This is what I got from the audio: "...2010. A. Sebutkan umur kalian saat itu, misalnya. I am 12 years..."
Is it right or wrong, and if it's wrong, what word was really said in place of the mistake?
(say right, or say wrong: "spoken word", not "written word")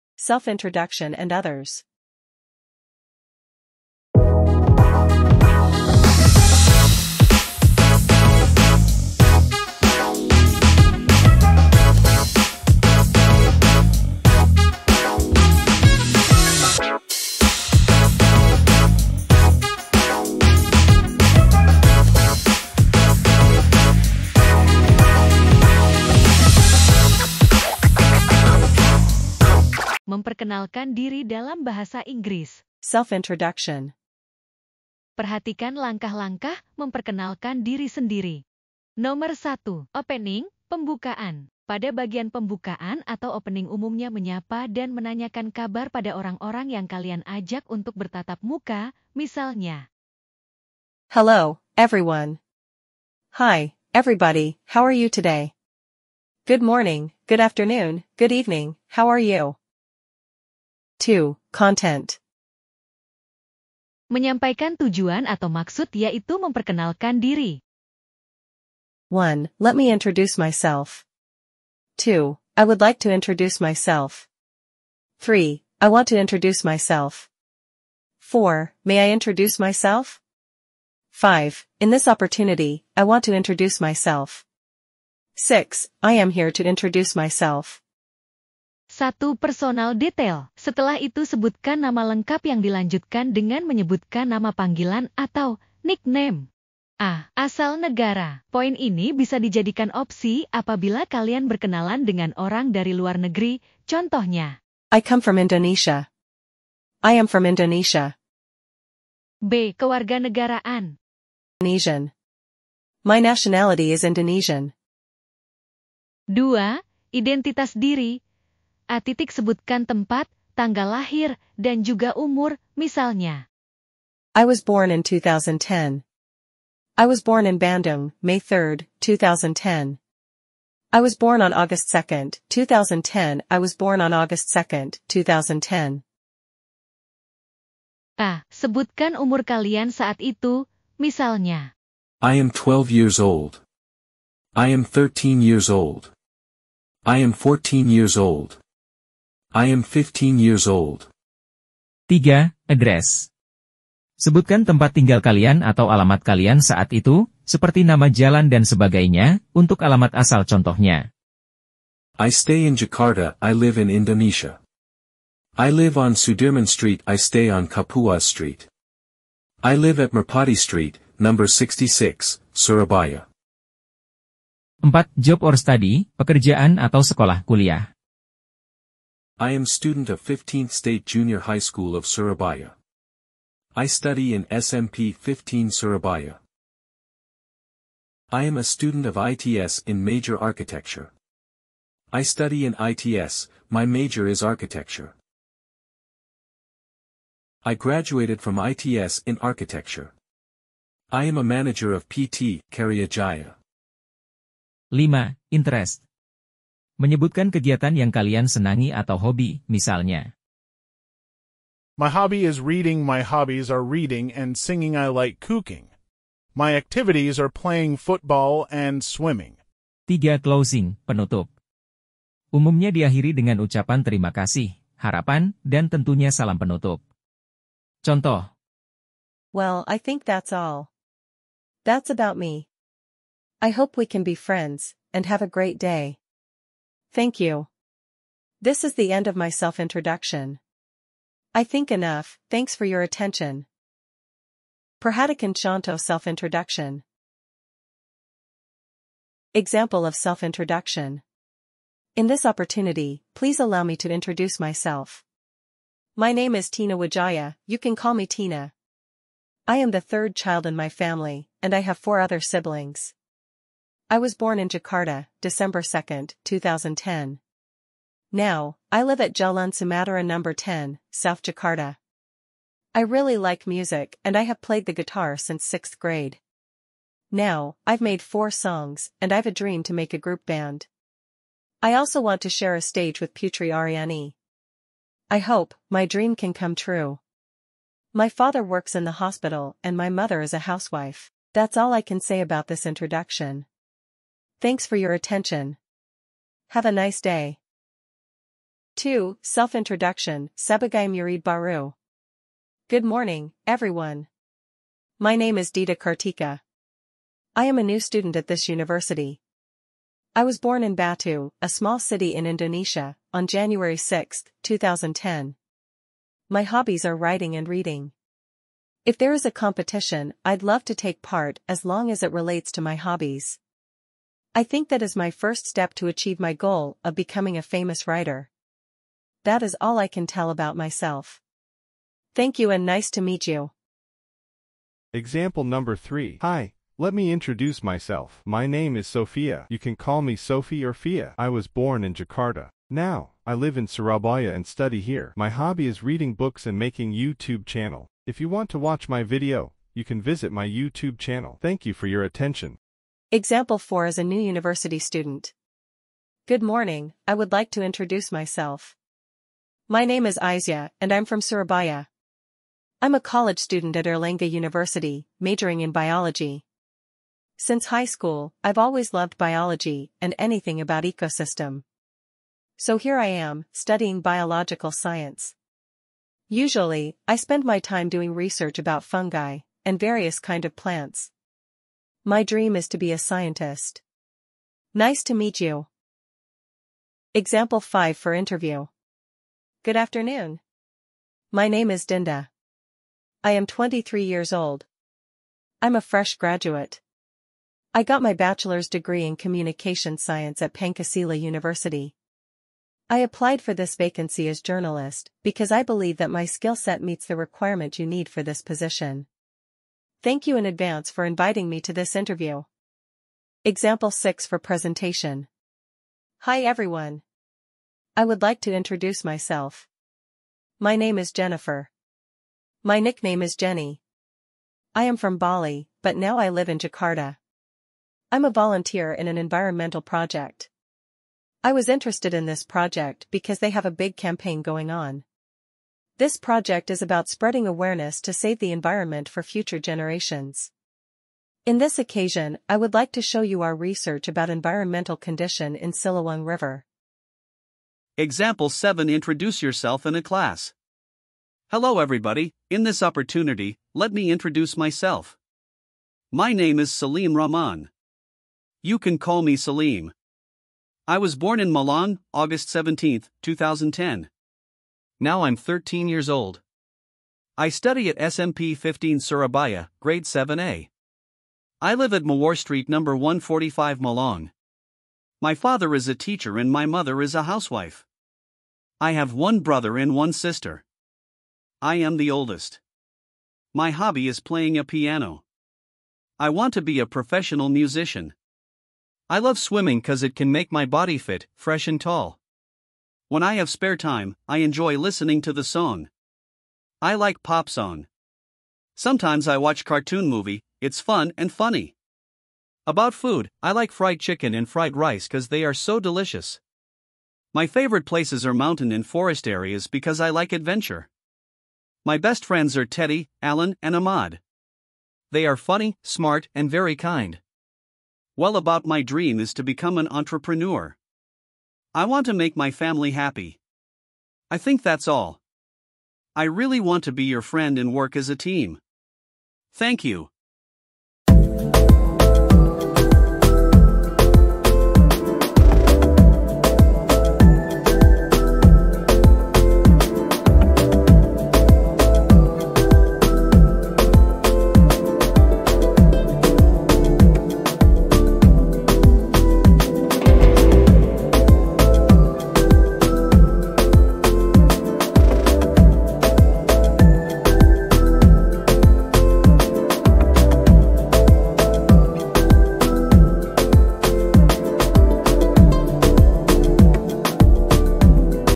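right.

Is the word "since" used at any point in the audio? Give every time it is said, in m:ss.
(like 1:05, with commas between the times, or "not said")
4:35, 6:07.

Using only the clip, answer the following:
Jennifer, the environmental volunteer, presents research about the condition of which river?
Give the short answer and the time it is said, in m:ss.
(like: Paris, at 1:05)
Silawang River, at 7:25.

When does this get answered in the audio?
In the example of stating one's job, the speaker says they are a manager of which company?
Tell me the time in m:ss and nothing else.
3:22.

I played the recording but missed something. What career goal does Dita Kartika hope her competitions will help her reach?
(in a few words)
famous writer.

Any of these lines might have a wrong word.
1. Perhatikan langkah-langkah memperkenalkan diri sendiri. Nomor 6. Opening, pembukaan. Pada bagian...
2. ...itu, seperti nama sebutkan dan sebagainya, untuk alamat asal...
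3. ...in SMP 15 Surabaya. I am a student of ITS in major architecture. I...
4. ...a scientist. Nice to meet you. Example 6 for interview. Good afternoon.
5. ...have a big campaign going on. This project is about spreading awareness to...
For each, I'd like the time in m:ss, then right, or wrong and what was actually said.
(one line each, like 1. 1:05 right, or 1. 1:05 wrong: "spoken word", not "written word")
1. 0:35 wrong: "1", not "6"
2. 2:36 wrong: "jalan", not "sebutkan"
3. 3:04 right
4. 6:23 wrong: "5", not "6"
5. 7:13 right.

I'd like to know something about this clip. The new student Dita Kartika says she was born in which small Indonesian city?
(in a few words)
Batu.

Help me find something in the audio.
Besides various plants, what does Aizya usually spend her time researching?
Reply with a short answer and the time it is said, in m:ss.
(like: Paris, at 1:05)
fungi, at 6:19.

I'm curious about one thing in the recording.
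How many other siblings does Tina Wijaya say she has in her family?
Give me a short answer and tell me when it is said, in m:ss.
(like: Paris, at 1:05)
4, at 4:21.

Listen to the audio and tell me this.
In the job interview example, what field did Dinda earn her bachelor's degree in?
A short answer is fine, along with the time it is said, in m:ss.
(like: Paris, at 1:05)
communication science, at 6:39.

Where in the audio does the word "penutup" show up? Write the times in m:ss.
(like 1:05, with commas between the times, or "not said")
3:41, 3:46.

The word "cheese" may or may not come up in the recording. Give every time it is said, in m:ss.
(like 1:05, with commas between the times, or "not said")
not said.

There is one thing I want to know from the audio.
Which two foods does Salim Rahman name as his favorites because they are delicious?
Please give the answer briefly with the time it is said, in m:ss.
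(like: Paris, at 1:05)
fried chicken and fried rice, at 8:23.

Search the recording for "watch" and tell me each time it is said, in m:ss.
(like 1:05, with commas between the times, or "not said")
5:48, 8:19.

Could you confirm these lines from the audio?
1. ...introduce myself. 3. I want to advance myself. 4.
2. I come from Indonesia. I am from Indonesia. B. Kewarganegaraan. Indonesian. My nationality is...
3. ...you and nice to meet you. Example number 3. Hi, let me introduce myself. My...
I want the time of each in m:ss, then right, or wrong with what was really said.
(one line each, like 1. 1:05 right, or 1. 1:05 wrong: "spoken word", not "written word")
1. 1:13 wrong: "introduce", not "advance"
2. 1:44 right
3. 5:32 right.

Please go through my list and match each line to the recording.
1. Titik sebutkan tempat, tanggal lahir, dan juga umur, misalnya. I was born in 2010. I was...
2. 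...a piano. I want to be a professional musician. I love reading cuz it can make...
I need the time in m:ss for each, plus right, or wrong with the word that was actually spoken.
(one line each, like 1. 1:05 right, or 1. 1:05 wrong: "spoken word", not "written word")
1. 1:58 right
2. 8:04 wrong: "swimming", not "reading".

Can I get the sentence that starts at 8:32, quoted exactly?
My best friends are Teddy, Alan, and Ahmad.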